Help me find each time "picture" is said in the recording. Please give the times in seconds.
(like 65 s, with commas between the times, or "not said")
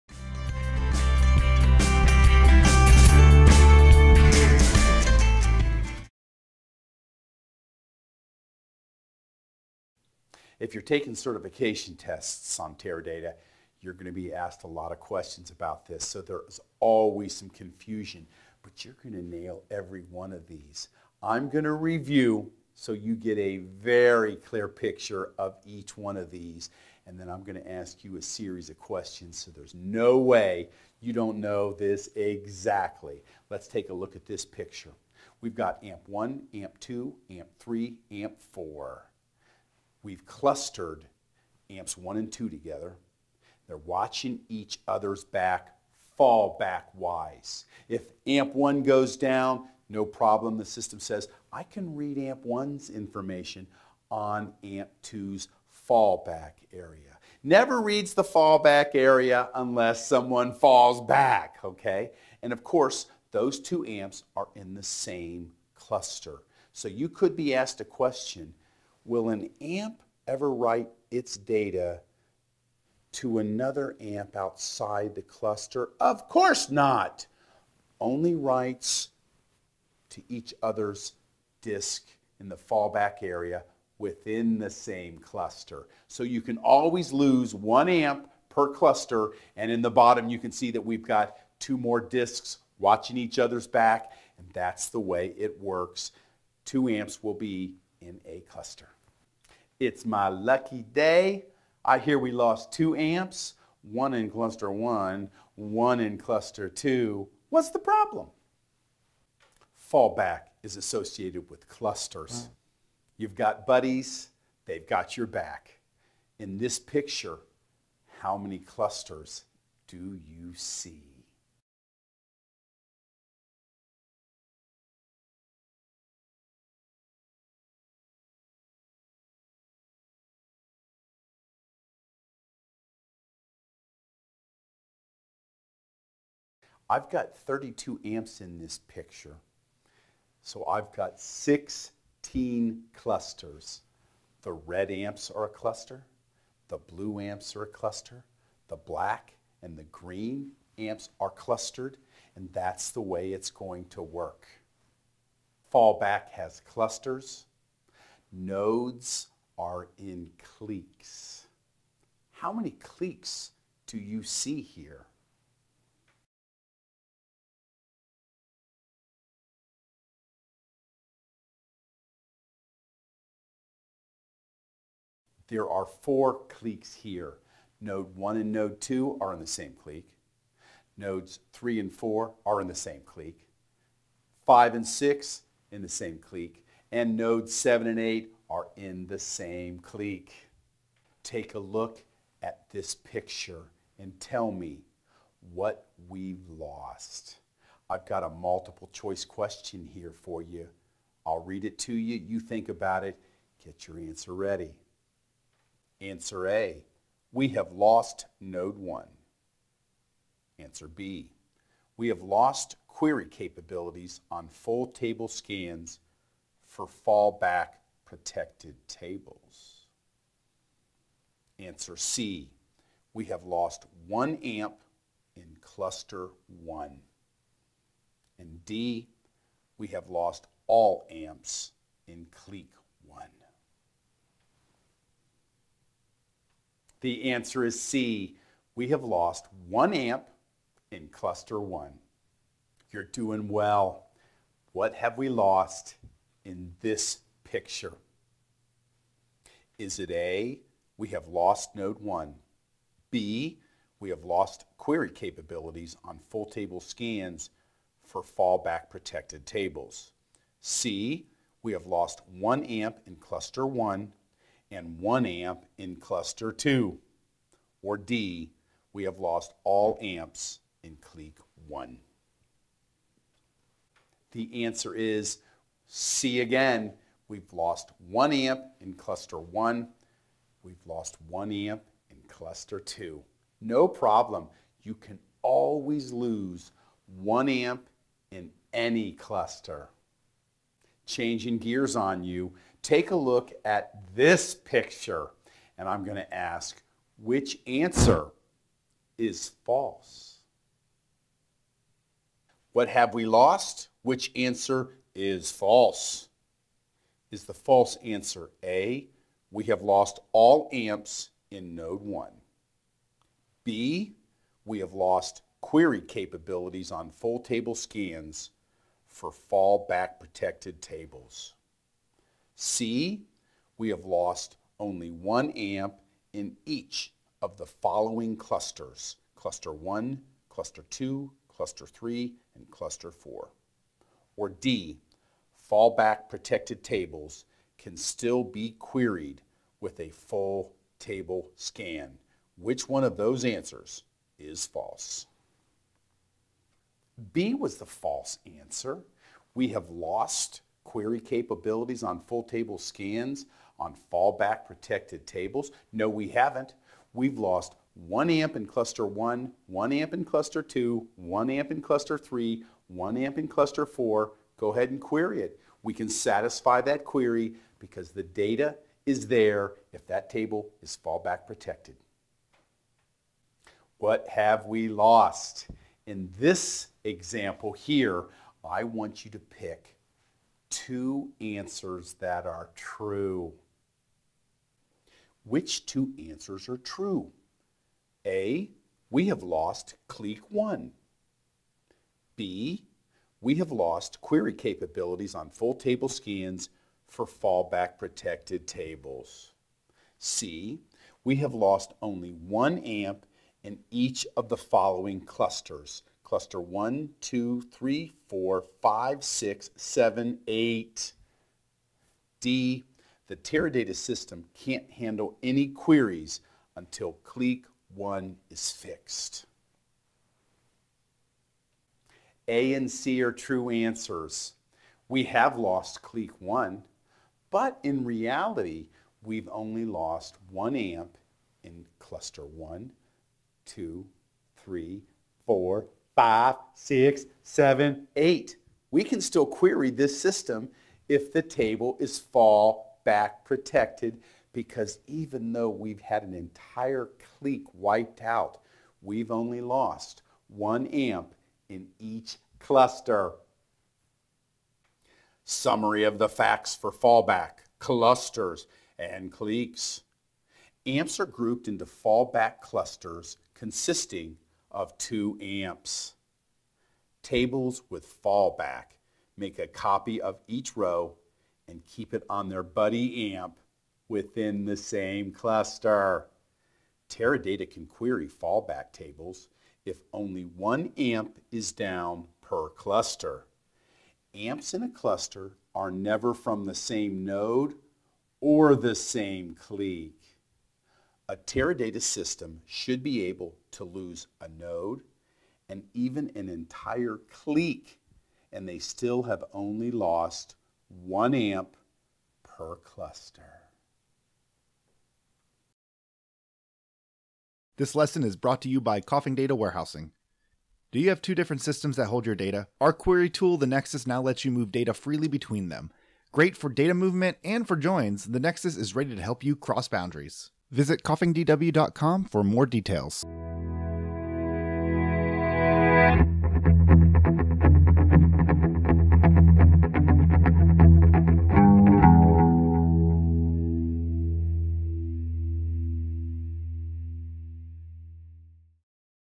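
24 s, 34 s, 116 s, 138 s, 192 s, 247 s, 294 s.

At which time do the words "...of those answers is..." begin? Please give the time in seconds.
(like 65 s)
343 s.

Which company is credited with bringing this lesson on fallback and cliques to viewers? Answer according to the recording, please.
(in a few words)
Coffing Data Warehousing.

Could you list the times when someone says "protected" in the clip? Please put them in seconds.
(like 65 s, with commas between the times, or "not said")
218 s, 258 s, 320 s, 336 s, 354 s, 371 s, 397 s, 443 s.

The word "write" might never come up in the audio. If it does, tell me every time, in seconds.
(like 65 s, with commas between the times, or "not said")
70 s, 78 s.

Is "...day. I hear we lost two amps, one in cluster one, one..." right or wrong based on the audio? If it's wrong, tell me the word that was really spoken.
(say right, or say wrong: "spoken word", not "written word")
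right.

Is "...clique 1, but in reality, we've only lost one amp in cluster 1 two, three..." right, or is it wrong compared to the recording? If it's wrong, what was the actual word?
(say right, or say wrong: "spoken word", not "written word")
right.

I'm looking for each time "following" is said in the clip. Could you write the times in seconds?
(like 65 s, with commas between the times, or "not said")
327 s, 404 s.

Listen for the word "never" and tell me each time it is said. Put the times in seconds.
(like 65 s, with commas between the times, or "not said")
57 s, 485 s.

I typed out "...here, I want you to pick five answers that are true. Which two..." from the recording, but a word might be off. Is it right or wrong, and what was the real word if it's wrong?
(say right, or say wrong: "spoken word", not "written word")
wrong: "two", not "five".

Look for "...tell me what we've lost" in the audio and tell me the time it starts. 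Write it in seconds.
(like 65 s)
194 s.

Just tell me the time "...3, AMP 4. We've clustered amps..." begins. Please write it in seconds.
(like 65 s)
37 s.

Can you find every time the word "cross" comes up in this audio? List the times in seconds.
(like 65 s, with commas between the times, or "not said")
519 s.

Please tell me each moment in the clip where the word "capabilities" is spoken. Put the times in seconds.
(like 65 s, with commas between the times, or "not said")
213 s, 255 s, 316 s, 351 s, 394 s.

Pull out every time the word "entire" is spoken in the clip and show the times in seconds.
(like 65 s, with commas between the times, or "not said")
446 s, 496 s.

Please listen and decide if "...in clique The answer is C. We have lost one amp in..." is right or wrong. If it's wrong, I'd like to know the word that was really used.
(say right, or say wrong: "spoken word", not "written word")
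right.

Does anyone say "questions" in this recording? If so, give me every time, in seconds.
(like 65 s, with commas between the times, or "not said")
14 s, 28 s, 67 s, 199 s.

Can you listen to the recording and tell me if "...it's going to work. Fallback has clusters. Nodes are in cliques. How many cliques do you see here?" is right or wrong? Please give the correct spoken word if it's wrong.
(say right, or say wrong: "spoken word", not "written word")
right.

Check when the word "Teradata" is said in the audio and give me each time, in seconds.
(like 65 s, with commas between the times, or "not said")
12 s, 413 s, 477 s, 491 s.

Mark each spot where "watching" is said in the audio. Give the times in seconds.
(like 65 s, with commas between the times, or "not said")
43 s, 92 s.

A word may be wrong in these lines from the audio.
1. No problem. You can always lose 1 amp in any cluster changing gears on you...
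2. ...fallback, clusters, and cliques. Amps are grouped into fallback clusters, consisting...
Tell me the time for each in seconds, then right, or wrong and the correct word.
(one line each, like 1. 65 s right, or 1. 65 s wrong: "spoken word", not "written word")
1. 283 s right
2. 456 s right.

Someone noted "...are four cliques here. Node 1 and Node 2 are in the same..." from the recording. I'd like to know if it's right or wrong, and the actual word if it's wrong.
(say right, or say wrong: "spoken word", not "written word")
right.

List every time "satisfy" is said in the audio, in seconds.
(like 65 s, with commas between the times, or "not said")
366 s.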